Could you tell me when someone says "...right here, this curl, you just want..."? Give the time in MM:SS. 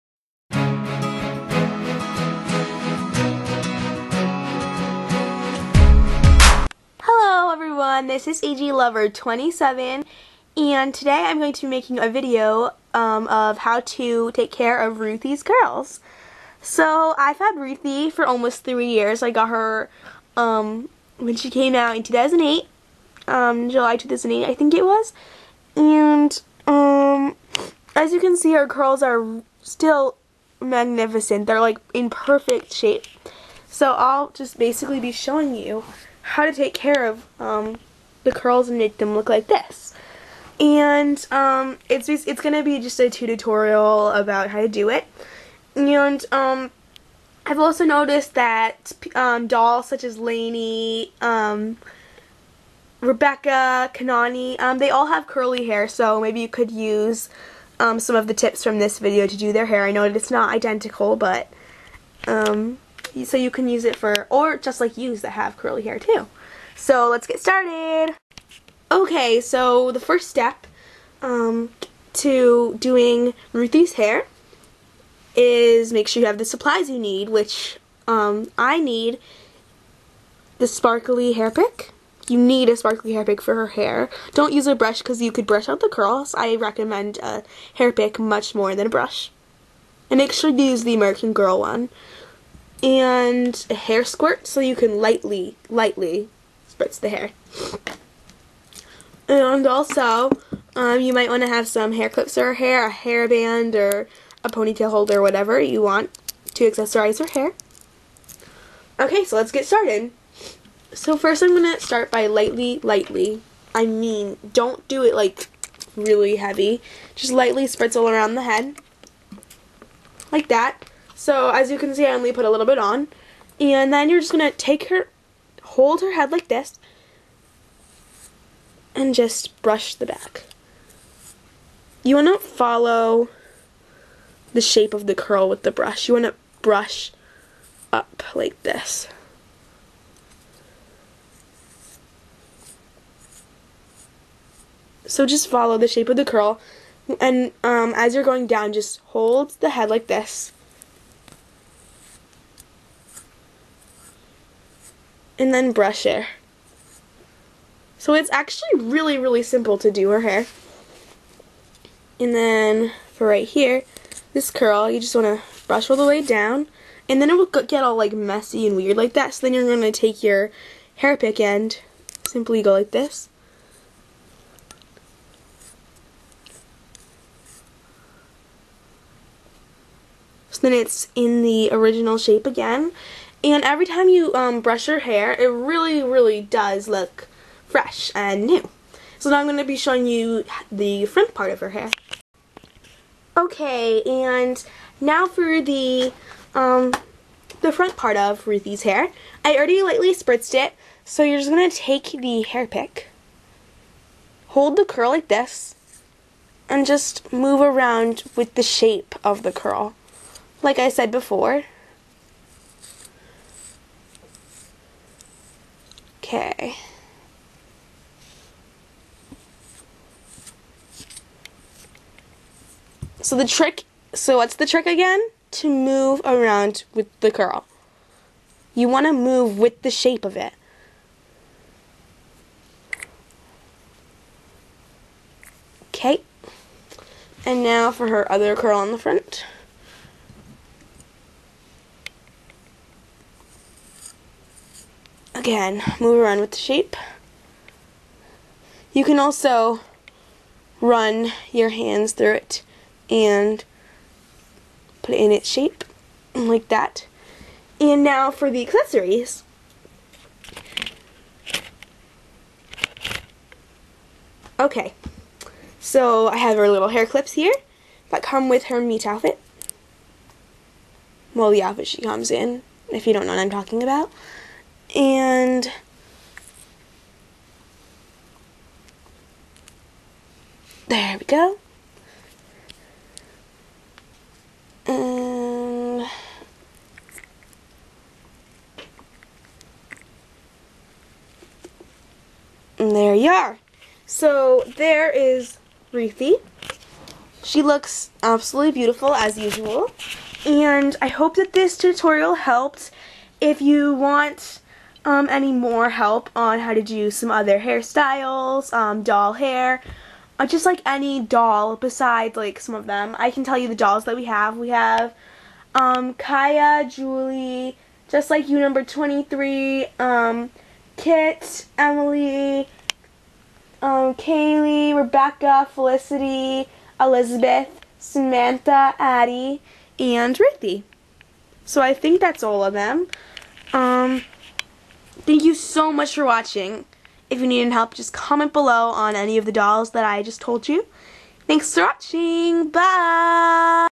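02:43.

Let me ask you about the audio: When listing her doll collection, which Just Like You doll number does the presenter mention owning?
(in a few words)
23.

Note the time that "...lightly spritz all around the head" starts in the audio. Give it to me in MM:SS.
01:57.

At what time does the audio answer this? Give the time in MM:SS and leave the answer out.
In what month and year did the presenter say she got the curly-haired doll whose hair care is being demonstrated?
00:23.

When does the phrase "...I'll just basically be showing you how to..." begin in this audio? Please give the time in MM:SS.
00:33.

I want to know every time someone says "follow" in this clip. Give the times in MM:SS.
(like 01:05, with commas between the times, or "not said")
02:12, 02:25.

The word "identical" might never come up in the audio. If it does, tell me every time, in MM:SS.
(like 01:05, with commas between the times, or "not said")
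01:00.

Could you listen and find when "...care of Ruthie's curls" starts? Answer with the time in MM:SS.
00:14.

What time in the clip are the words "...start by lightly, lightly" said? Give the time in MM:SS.
01:51.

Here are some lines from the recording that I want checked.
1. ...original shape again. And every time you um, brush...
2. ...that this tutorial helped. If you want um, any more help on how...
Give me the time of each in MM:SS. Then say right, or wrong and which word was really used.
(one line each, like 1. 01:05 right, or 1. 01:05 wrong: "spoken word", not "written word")
1. 03:01 right
2. 05:01 right.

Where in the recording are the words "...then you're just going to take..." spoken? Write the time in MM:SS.
02:03.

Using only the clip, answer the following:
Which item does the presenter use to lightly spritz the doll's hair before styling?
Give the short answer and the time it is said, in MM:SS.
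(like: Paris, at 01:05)
Hair squirt, at 01:33.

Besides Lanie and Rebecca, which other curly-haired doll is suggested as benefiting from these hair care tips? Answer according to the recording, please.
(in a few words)
Kanani.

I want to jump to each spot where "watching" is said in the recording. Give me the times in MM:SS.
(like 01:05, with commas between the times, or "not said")
05:36, 05:41.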